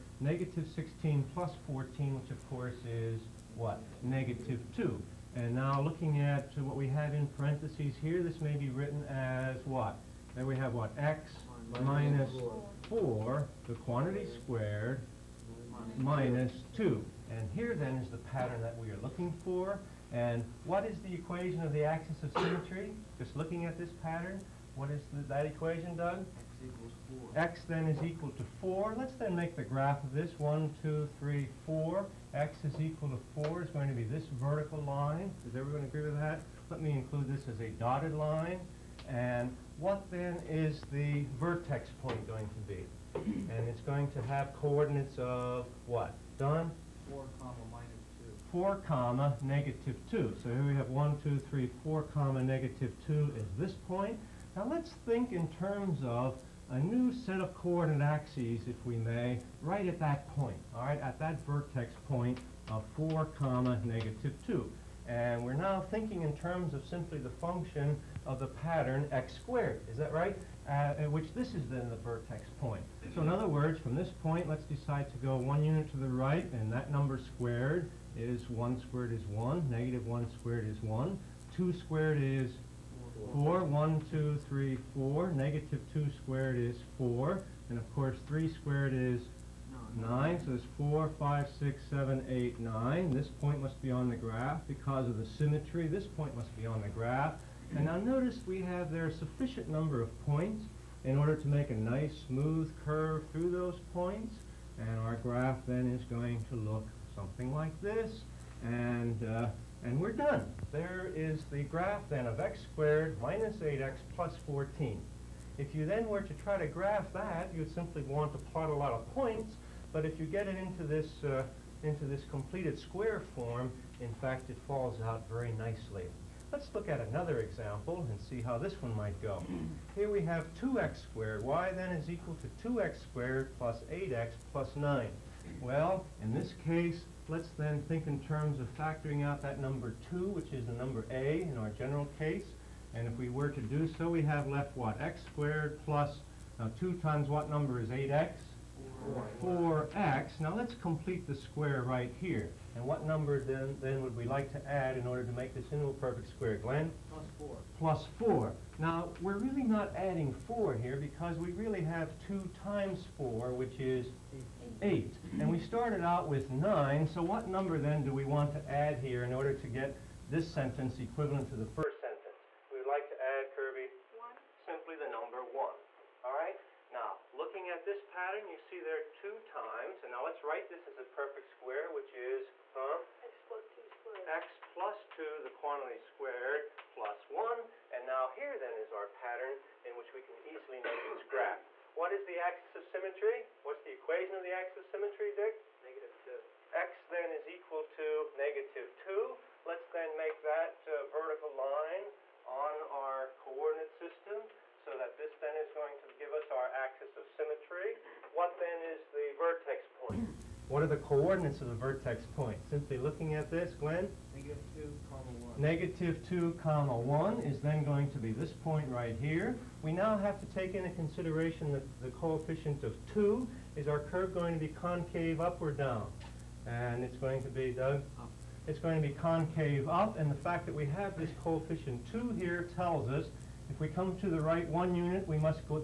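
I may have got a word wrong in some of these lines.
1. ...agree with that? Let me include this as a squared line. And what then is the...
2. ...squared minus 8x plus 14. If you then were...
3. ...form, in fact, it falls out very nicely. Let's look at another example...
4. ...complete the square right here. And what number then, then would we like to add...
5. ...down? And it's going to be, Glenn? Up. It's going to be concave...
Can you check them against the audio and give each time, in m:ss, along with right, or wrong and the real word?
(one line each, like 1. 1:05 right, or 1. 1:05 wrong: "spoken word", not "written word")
1. 0:35 wrong: "dotted", not "squared"
2. 1:52 right
3. 2:03 right
4. 2:30 right
5. 3:45 wrong: "Doug", not "Glenn".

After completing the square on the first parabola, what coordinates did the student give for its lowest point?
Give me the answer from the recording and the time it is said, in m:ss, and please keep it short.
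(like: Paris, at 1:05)
(4, -2), at 0:47.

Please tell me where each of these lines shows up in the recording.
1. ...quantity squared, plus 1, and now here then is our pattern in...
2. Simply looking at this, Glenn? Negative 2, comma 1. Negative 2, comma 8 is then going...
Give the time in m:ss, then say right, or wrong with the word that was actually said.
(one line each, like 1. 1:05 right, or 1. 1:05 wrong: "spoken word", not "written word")
1. 3:05 right
2. 3:32 wrong: "1", not "8".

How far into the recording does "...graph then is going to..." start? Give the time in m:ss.
1:45.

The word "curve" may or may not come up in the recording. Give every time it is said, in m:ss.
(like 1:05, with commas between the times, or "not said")
1:42, 3:43.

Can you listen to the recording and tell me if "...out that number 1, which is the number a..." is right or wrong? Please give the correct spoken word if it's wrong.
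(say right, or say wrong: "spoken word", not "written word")
wrong: "2", not "1".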